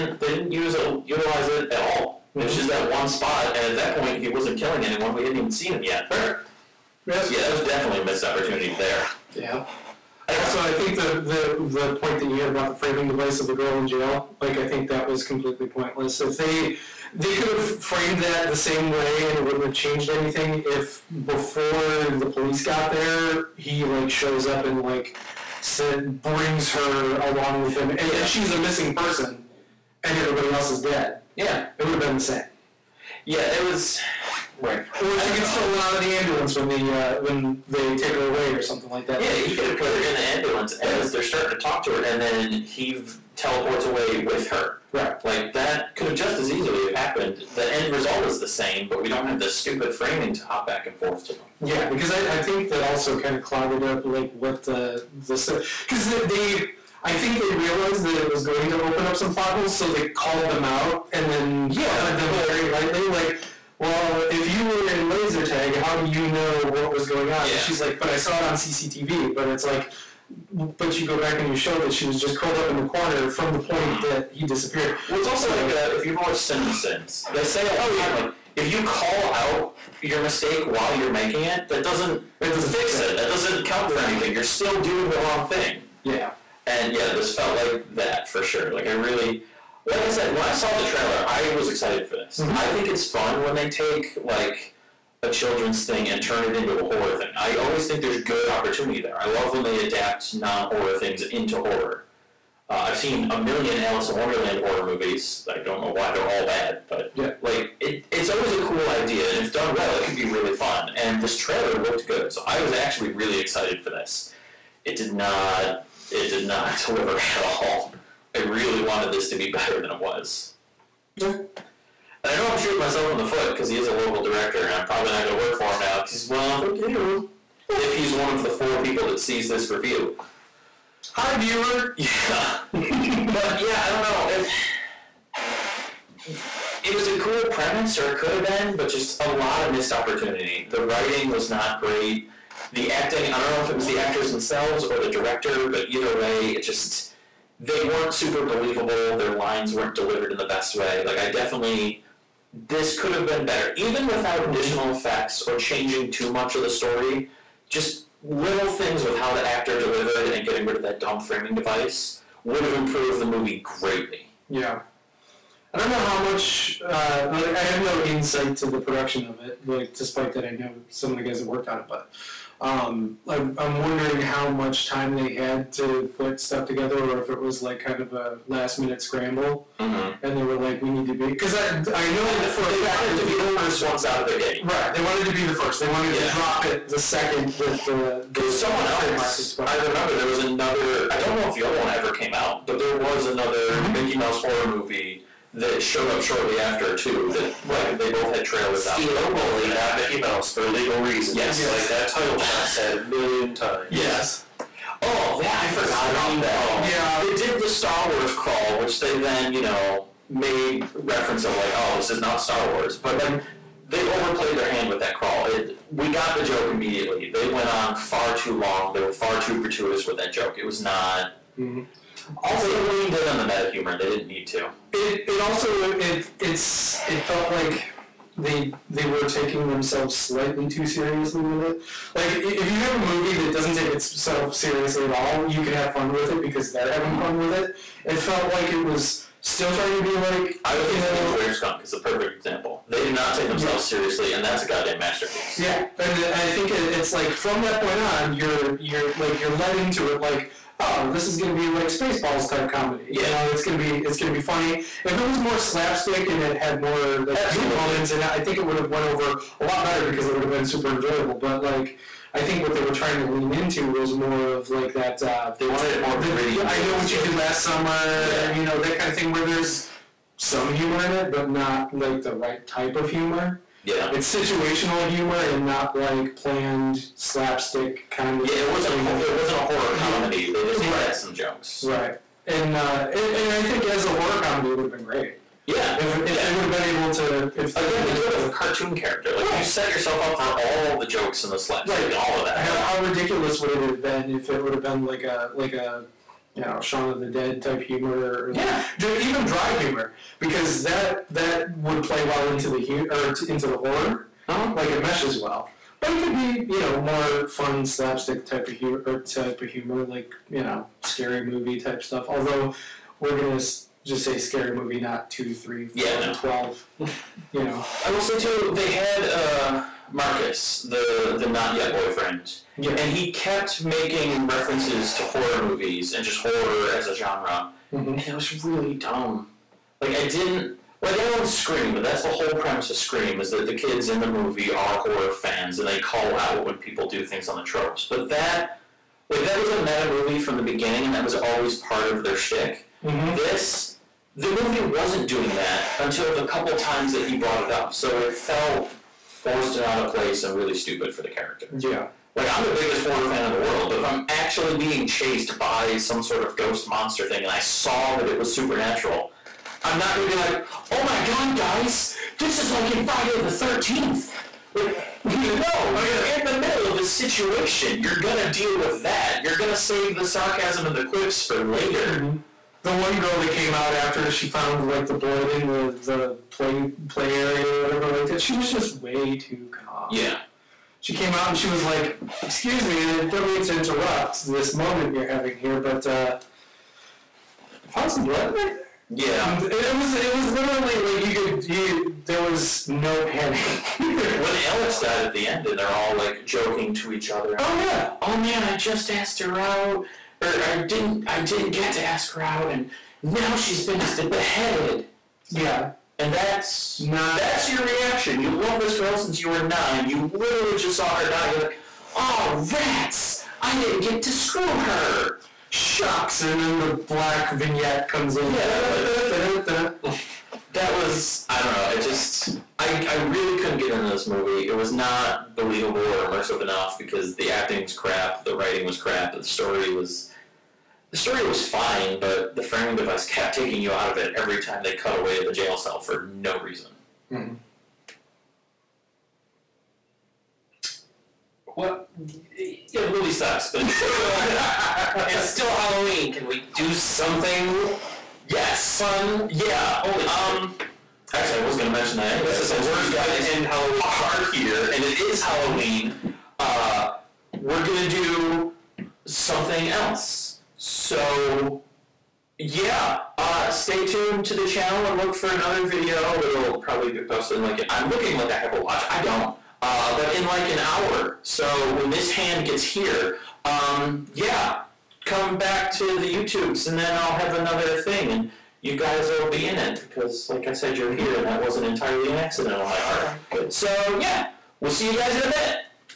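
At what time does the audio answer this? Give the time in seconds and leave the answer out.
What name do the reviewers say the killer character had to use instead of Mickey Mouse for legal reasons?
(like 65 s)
198 s.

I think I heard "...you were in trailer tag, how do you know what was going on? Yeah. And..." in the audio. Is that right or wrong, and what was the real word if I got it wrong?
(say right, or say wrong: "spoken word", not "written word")
wrong: "laser", not "trailer".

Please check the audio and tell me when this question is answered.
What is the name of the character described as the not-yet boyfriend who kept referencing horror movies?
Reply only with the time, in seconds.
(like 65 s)
320 s.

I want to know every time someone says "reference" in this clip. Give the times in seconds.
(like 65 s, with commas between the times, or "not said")
210 s, 324 s.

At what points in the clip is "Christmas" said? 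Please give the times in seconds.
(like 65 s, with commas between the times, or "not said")
not said.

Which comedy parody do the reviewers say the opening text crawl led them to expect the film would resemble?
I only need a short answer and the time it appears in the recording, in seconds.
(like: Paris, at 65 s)
Spaceballs, at 251 s.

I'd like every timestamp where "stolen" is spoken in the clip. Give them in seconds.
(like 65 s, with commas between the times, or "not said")
35 s.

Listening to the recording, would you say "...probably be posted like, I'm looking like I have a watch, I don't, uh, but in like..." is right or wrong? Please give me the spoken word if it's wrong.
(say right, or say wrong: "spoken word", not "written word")
right.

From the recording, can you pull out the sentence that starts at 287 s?
If Again, the killer's a cartoon character.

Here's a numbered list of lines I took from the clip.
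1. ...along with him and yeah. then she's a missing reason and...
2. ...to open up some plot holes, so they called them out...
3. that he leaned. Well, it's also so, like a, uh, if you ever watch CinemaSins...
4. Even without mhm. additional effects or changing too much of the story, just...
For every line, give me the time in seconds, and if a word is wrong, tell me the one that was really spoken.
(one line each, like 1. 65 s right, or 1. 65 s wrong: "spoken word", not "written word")
1. 27 s wrong: "person", not "reason"
2. 58 s right
3. 74 s wrong: "disappeared", not "leaned"
4. 153 s right.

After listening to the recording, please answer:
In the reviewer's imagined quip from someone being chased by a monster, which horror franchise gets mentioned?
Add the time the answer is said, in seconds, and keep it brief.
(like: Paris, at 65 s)
Friday the Thirteenth, at 363 s.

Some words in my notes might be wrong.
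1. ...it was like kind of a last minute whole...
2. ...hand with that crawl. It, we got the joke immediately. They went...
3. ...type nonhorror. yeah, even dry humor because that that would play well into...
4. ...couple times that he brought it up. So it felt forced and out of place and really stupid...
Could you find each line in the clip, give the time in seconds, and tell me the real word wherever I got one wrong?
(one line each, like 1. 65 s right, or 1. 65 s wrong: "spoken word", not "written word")
1. 177 s wrong: "scramble", not "whole"
2. 214 s right
3. 297 s wrong: "humor", not "nonhorror"
4. 346 s right.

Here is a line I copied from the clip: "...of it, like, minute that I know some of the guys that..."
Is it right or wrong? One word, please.
wrong.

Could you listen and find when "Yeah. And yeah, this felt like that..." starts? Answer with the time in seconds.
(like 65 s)
86 s.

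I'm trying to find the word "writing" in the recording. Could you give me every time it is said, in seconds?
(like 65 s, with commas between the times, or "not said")
140 s, 428 s.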